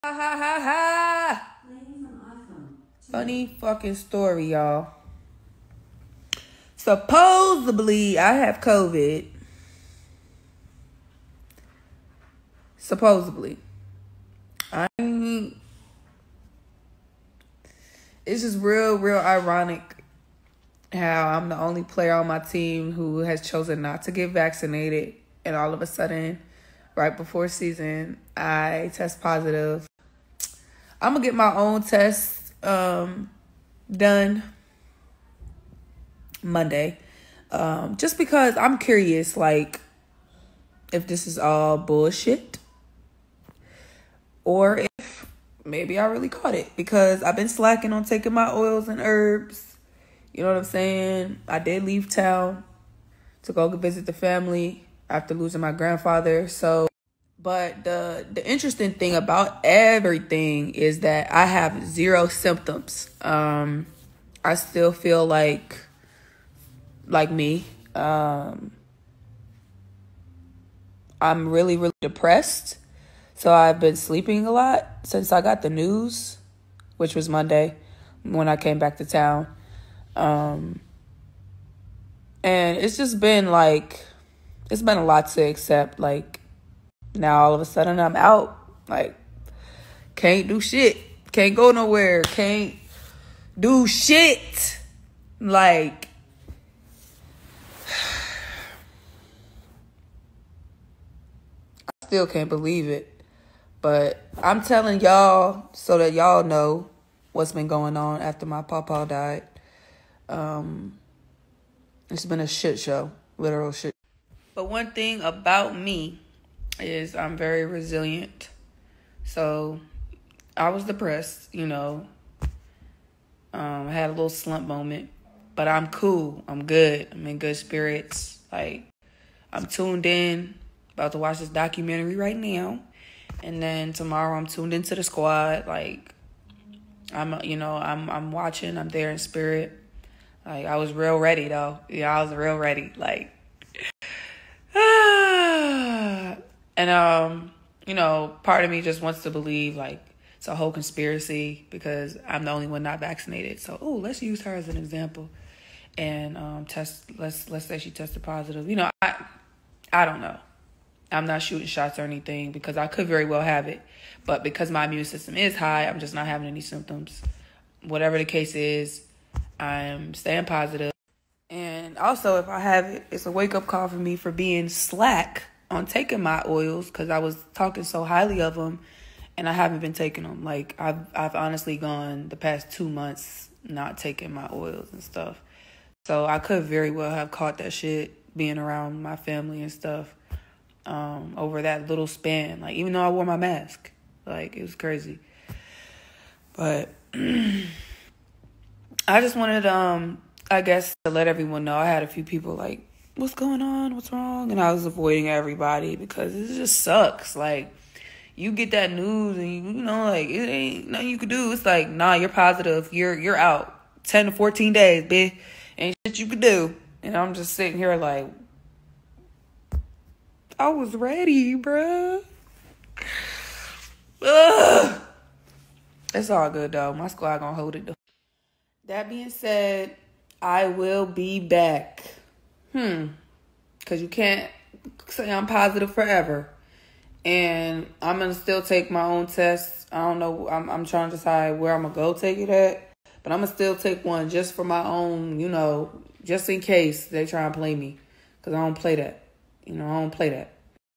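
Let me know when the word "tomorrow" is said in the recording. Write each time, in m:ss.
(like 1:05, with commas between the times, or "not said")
2:13.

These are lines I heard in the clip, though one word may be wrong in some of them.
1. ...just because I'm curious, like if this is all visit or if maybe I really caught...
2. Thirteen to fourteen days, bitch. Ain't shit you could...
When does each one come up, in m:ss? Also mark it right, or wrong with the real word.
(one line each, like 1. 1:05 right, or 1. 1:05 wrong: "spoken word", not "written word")
1. 0:37 wrong: "bullshit", not "visit"
2. 3:34 wrong: "Ten", not "Thirteen".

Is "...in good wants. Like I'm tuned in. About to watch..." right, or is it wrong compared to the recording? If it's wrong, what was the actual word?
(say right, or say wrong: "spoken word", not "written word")
wrong: "spirits", not "wants".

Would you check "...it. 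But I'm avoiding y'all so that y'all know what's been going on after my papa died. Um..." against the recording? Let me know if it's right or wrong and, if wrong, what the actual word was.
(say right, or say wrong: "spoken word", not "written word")
wrong: "telling", not "avoiding".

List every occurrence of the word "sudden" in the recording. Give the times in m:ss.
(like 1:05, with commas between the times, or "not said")
0:25, 1:27.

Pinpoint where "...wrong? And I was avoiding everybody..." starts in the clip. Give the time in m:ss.
3:24.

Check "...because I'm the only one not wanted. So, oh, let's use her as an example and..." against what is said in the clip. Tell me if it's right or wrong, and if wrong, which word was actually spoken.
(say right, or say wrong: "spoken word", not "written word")
wrong: "vaccinated", not "wanted".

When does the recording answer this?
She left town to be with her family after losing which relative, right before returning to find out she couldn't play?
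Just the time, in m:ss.
0:55.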